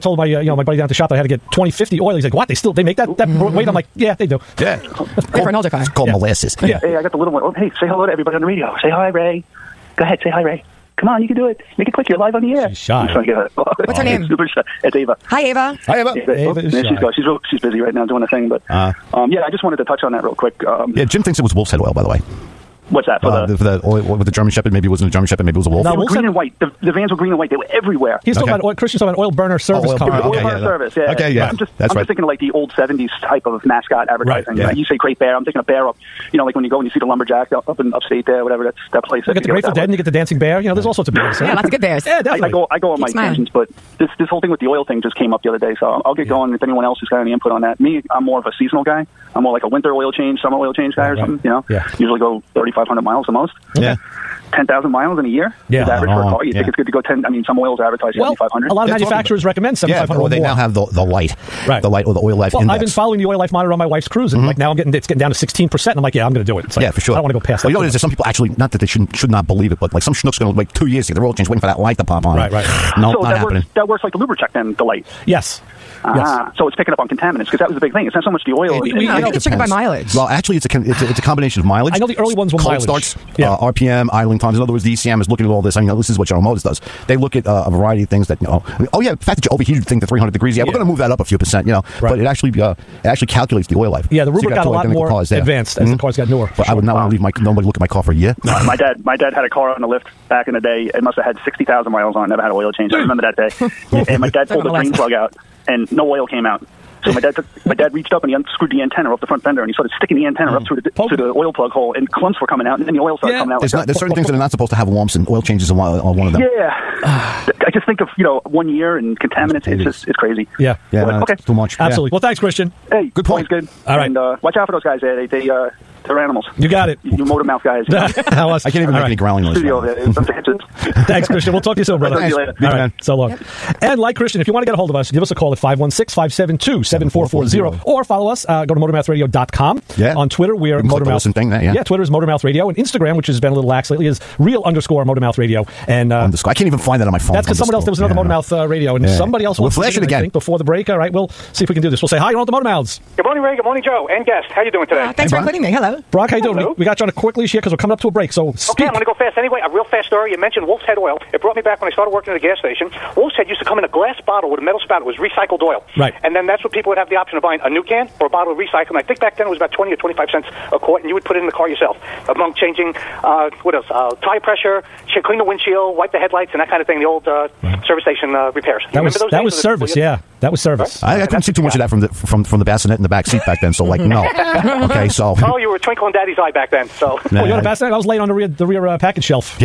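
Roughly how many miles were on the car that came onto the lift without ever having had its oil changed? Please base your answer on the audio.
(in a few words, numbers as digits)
60,000.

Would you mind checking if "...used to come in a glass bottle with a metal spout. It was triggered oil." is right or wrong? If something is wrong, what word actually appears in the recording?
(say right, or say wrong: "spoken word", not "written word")
wrong: "recycled", not "triggered".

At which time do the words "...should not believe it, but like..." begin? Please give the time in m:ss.
1:09.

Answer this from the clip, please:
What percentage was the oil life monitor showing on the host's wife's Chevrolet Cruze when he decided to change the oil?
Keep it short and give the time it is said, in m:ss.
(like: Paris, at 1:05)
16%, at 1:05.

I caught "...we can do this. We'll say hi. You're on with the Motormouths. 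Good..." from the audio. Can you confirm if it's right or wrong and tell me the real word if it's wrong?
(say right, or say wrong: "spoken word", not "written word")
right.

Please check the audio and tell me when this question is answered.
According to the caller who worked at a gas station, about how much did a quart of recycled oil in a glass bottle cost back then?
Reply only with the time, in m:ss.
2:49.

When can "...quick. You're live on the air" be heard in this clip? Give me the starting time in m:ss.
0:11.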